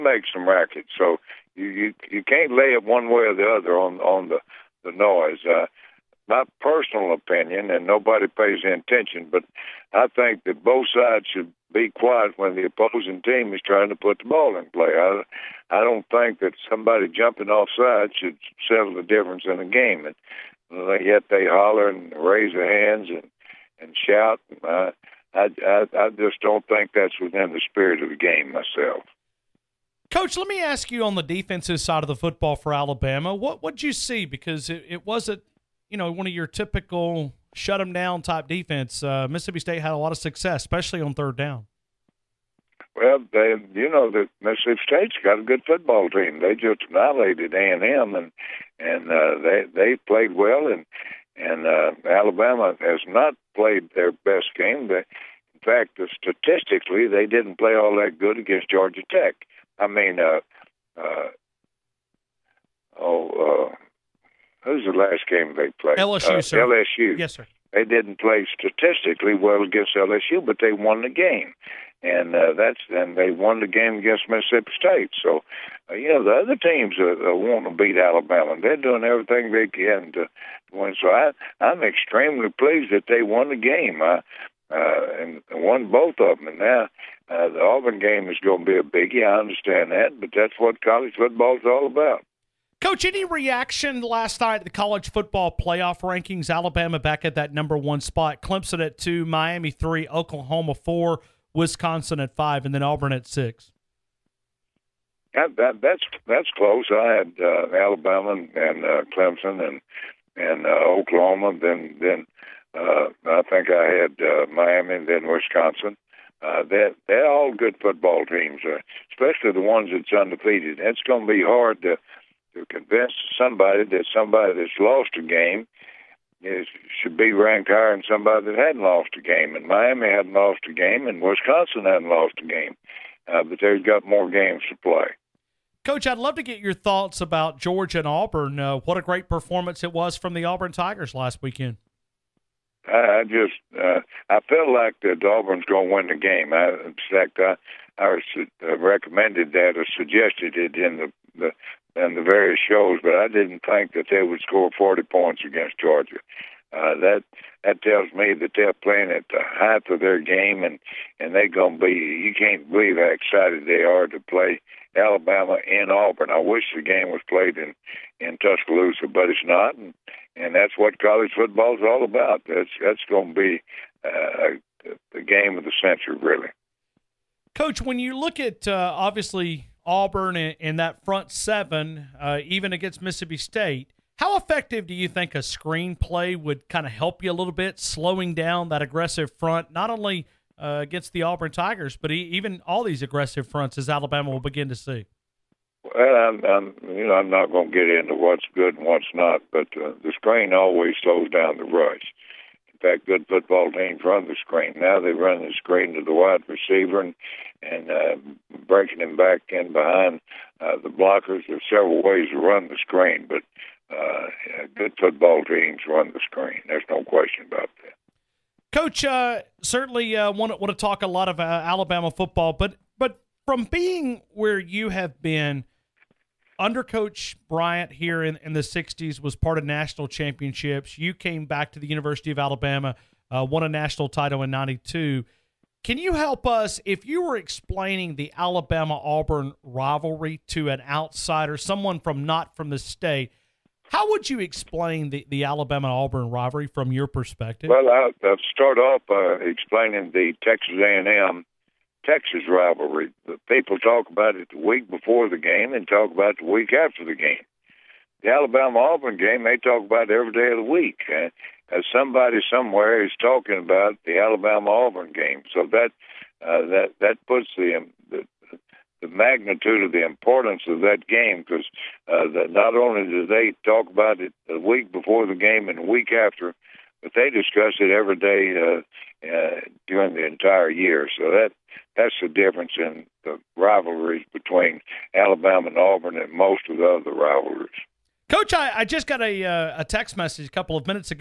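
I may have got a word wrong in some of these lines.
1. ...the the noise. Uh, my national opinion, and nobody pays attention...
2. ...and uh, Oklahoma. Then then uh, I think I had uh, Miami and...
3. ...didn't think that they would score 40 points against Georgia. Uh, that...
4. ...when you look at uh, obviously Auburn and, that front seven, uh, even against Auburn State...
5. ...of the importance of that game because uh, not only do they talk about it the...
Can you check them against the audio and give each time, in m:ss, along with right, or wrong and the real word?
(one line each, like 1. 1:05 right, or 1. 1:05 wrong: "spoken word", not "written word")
1. 0:04 wrong: "personal", not "national"
2. 1:50 right
3. 2:33 right
4. 2:57 wrong: "Mississippi", not "Auburn"
5. 4:29 right.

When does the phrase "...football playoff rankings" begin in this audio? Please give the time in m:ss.
1:35.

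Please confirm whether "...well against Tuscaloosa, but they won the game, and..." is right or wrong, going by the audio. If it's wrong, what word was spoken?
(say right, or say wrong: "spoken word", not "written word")
wrong: "LSU", not "Tuscaloosa".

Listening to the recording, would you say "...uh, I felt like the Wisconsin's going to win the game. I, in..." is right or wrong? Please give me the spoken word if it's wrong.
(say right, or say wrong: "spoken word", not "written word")
wrong: "Auburn", not "Wisconsin".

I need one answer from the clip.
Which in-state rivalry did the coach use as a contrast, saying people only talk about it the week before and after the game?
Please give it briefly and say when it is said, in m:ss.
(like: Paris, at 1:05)
Texas A&M Texas, at 4:10.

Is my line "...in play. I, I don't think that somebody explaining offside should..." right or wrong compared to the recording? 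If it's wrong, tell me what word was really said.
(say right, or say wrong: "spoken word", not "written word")
wrong: "jumping", not "explaining".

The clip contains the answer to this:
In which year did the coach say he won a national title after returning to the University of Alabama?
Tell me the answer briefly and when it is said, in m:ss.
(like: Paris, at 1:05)
1992, at 3:54.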